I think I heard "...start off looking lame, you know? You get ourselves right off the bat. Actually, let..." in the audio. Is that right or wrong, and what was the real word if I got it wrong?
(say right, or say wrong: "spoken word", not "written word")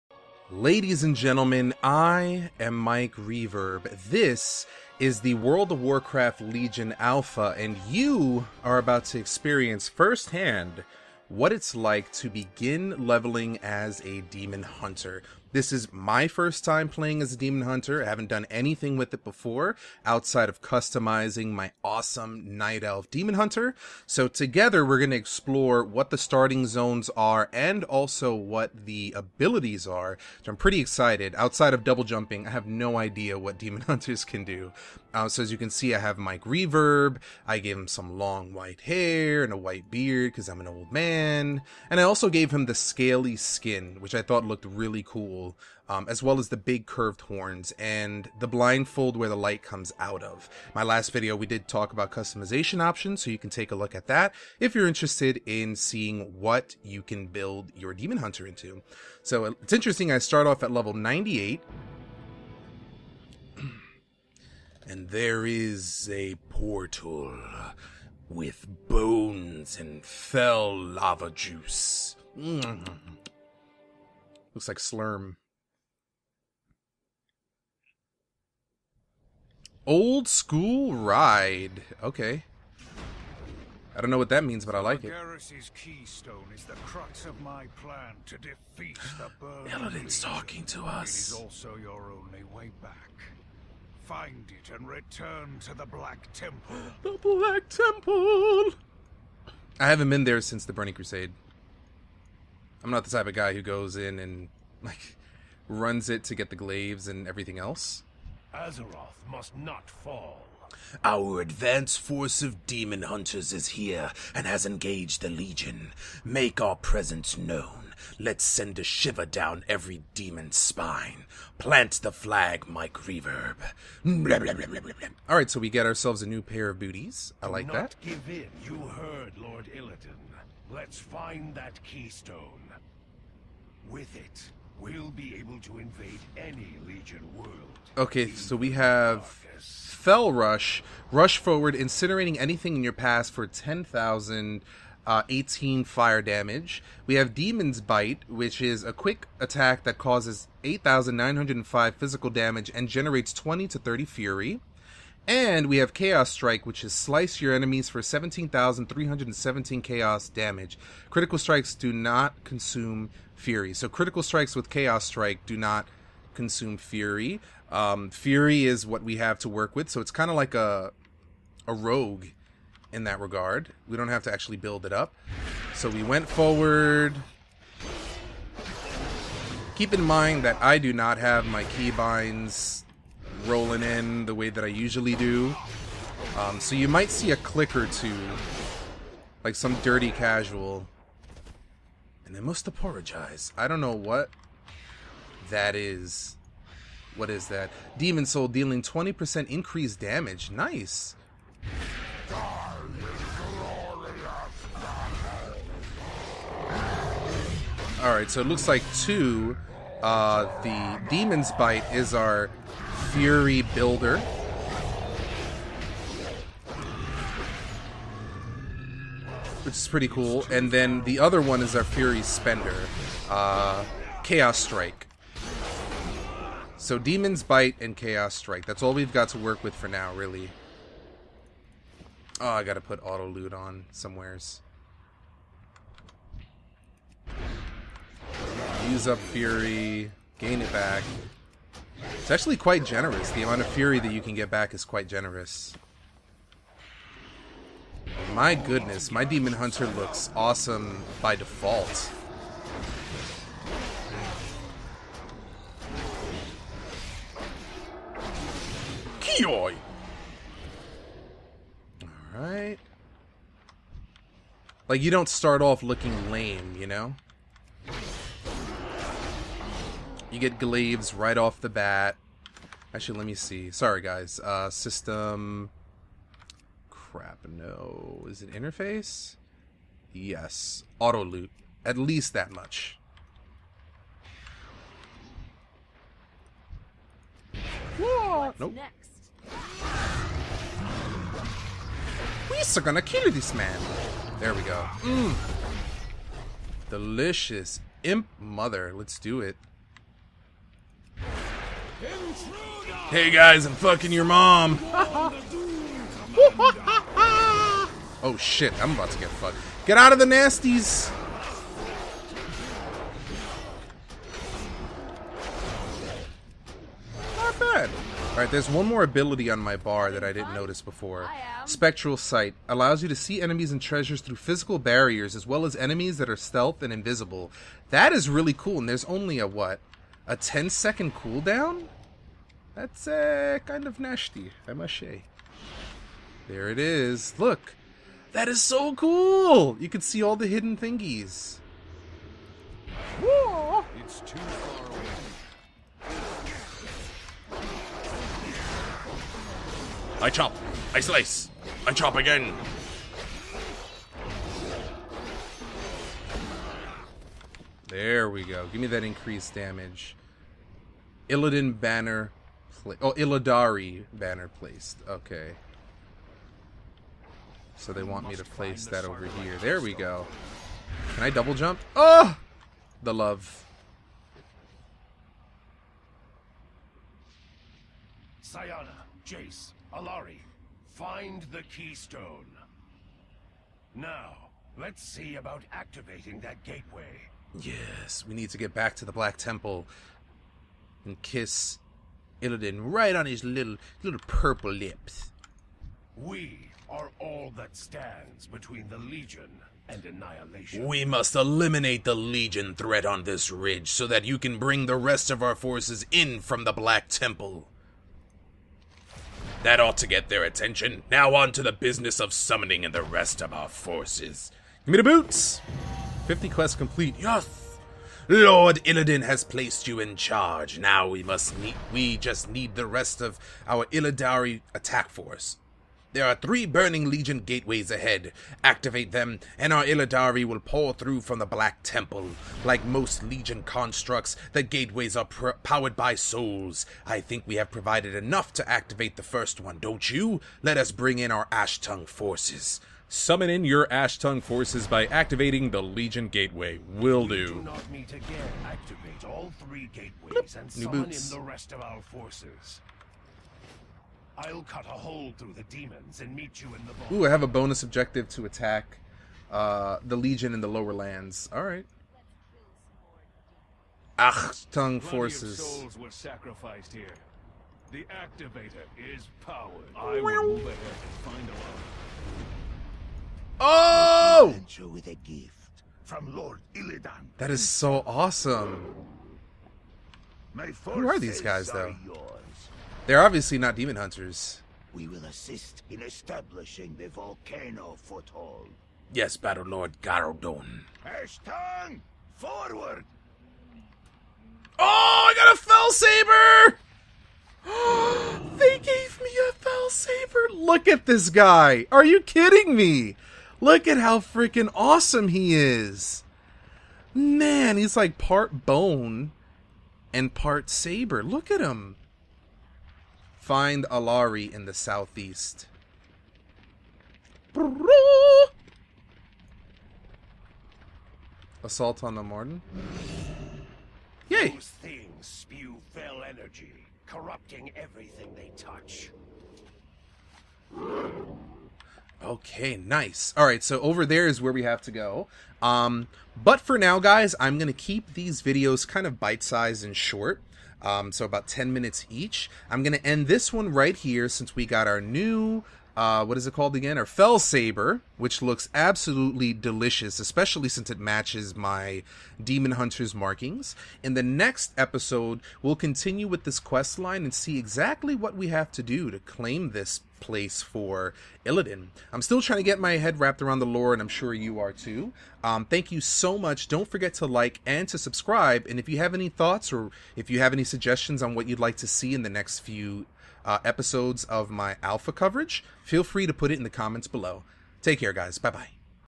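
wrong: "glaives", not "ourselves".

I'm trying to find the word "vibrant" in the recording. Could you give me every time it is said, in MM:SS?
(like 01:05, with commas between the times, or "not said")
not said.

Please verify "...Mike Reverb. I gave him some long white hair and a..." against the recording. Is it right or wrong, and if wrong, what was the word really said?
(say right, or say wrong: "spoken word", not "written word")
right.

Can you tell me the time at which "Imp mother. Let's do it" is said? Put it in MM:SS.
04:58.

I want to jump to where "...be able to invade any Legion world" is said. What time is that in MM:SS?
02:15.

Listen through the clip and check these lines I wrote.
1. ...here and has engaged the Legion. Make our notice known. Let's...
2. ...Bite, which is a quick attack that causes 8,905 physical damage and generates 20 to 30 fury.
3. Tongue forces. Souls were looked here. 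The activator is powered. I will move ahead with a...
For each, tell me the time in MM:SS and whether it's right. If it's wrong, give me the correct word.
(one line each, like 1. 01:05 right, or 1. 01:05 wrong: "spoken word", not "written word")
1. 01:53 wrong: "presence", not "notice"
2. 02:27 right
3. 07:44 wrong: "sacrificed", not "looked".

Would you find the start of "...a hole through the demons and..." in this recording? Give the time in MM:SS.
07:34.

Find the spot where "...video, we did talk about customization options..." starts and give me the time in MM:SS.
00:51.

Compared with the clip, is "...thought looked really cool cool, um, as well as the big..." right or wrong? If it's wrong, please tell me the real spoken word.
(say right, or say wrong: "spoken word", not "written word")
right.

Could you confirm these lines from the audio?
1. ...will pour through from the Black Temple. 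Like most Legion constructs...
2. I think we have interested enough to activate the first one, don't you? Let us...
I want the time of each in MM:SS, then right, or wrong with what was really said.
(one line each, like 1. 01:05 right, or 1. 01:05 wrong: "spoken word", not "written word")
1. 07:10 right
2. 07:17 wrong: "provided", not "interested".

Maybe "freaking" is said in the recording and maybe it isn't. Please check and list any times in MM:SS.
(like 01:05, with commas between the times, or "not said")
08:24.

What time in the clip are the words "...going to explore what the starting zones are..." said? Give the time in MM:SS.
00:24.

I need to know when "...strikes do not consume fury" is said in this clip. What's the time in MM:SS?
02:41.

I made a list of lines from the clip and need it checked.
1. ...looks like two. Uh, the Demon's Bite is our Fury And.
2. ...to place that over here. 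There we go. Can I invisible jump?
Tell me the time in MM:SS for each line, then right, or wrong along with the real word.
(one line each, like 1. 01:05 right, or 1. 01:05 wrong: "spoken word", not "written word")
1. 03:28 wrong: "Builder", not "And"
2. 06:08 wrong: "double", not "invisible".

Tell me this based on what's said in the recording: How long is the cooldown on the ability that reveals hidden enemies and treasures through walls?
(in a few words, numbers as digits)
10 seconds.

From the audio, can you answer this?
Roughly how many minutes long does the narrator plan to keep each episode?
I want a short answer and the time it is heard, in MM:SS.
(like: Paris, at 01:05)
10, at 09:01.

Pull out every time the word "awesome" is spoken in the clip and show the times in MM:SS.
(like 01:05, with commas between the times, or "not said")
00:21, 04:10, 07:58, 08:24.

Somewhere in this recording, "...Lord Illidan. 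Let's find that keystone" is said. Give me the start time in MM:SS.
02:09.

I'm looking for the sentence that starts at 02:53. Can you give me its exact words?
We don't have to actually build it up.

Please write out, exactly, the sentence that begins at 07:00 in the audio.
Now we must need, we just need the rest of our Illidari attack force.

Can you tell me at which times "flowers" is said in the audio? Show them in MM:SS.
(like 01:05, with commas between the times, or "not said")
not said.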